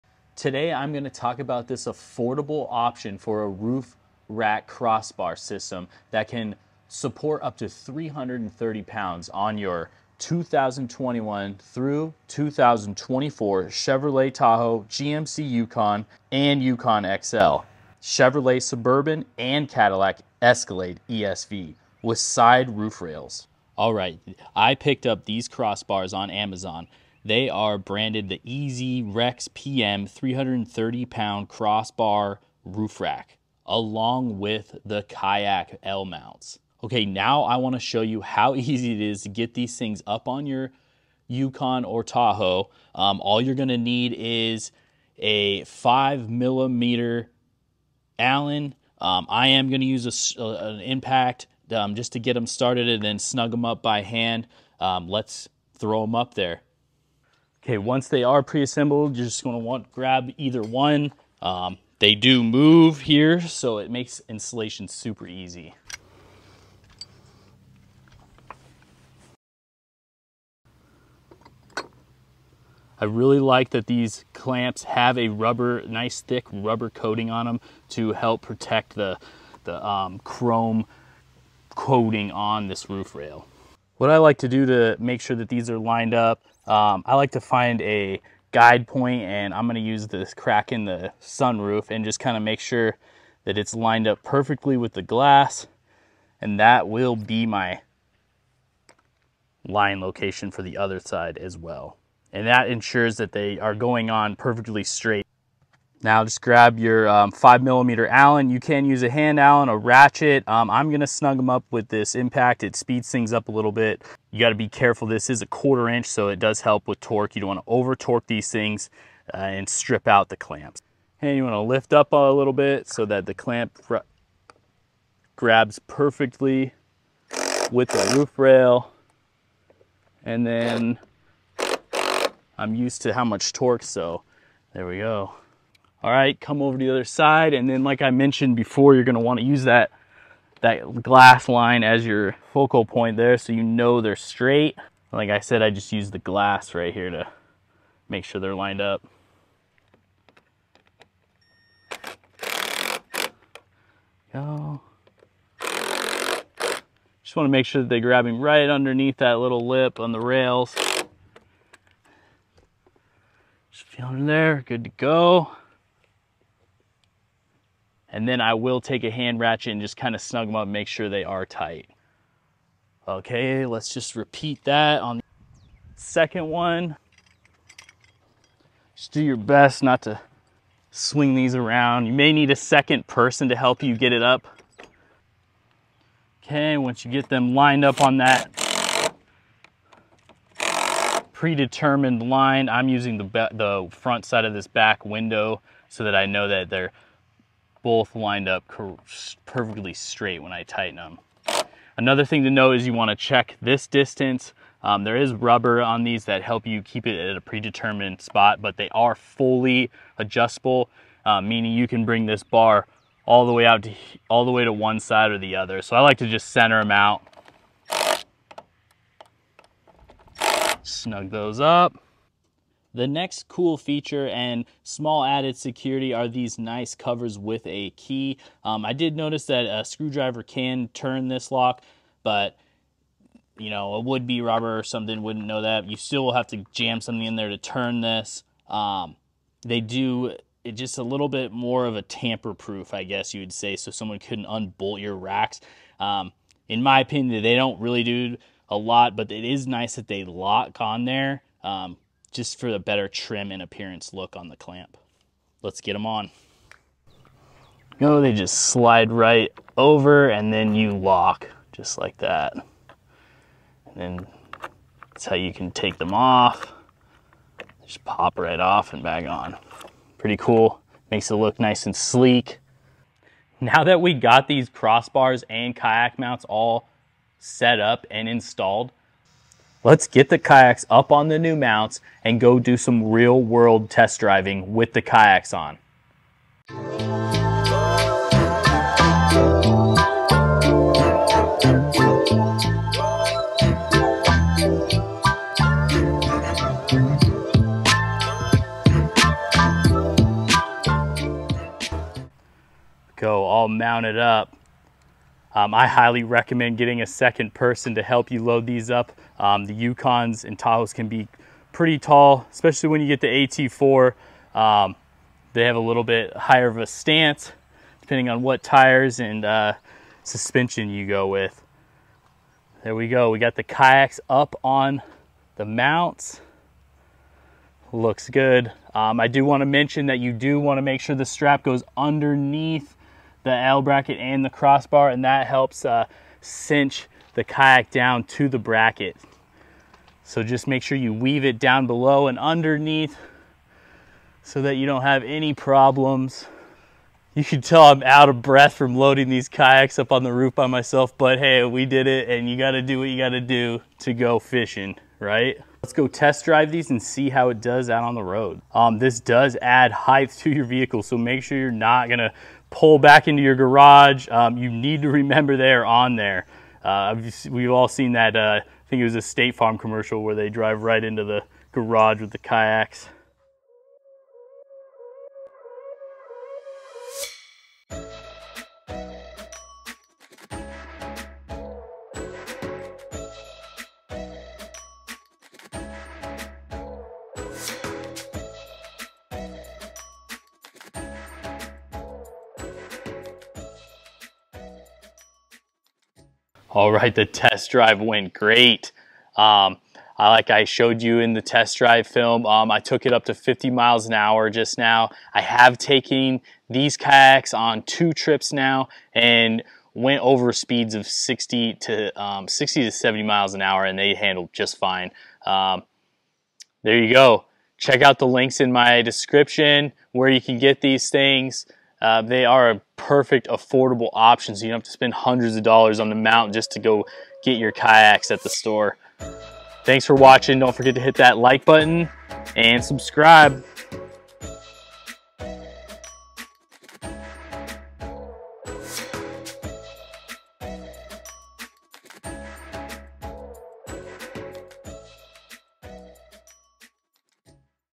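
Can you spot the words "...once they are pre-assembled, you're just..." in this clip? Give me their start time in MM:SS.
00:57.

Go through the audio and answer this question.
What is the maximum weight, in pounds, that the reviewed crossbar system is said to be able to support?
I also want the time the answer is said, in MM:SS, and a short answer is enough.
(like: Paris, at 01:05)
330, at 00:07.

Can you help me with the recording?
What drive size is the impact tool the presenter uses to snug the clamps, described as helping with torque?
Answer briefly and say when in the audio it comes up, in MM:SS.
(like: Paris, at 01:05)
quarter inch, at 01:55.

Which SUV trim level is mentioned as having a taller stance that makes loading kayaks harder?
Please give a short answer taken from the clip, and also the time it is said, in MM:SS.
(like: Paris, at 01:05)
AT4, at 05:13.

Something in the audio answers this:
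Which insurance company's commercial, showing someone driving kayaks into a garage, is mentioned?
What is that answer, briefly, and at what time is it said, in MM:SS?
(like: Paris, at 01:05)
State Farm, at 06:09.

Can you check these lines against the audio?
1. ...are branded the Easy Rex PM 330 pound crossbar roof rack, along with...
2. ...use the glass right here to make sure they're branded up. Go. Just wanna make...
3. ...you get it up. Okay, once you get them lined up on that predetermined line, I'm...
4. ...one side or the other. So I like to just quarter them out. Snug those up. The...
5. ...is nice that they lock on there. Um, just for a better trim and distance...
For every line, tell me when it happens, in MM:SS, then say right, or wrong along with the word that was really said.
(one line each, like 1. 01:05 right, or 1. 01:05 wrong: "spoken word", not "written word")
1. 00:27 right
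2. 02:25 wrong: "lined", not "branded"
3. 03:03 right
4. 03:34 wrong: "center", not "quarter"
5. 04:09 wrong: "appearance", not "distance".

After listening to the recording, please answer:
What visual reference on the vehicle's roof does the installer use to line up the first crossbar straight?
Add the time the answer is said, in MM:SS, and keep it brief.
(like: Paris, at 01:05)
crack in the sunroof, at 01:30.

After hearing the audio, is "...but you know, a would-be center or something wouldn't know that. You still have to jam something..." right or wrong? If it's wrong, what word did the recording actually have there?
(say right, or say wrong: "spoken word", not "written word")
wrong: "robber", not "center".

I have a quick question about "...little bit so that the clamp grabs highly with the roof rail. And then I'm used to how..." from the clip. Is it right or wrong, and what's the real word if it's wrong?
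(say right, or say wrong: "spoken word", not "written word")
wrong: "perfectly", not "highly".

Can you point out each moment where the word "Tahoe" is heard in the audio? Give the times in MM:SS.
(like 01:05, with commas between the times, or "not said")
00:14, 00:42, 05:10.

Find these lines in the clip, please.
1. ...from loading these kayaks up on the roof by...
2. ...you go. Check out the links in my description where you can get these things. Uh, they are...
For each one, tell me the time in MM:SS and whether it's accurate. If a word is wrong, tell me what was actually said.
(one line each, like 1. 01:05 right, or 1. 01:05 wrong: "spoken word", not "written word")
1. 05:48 right
2. 06:57 right.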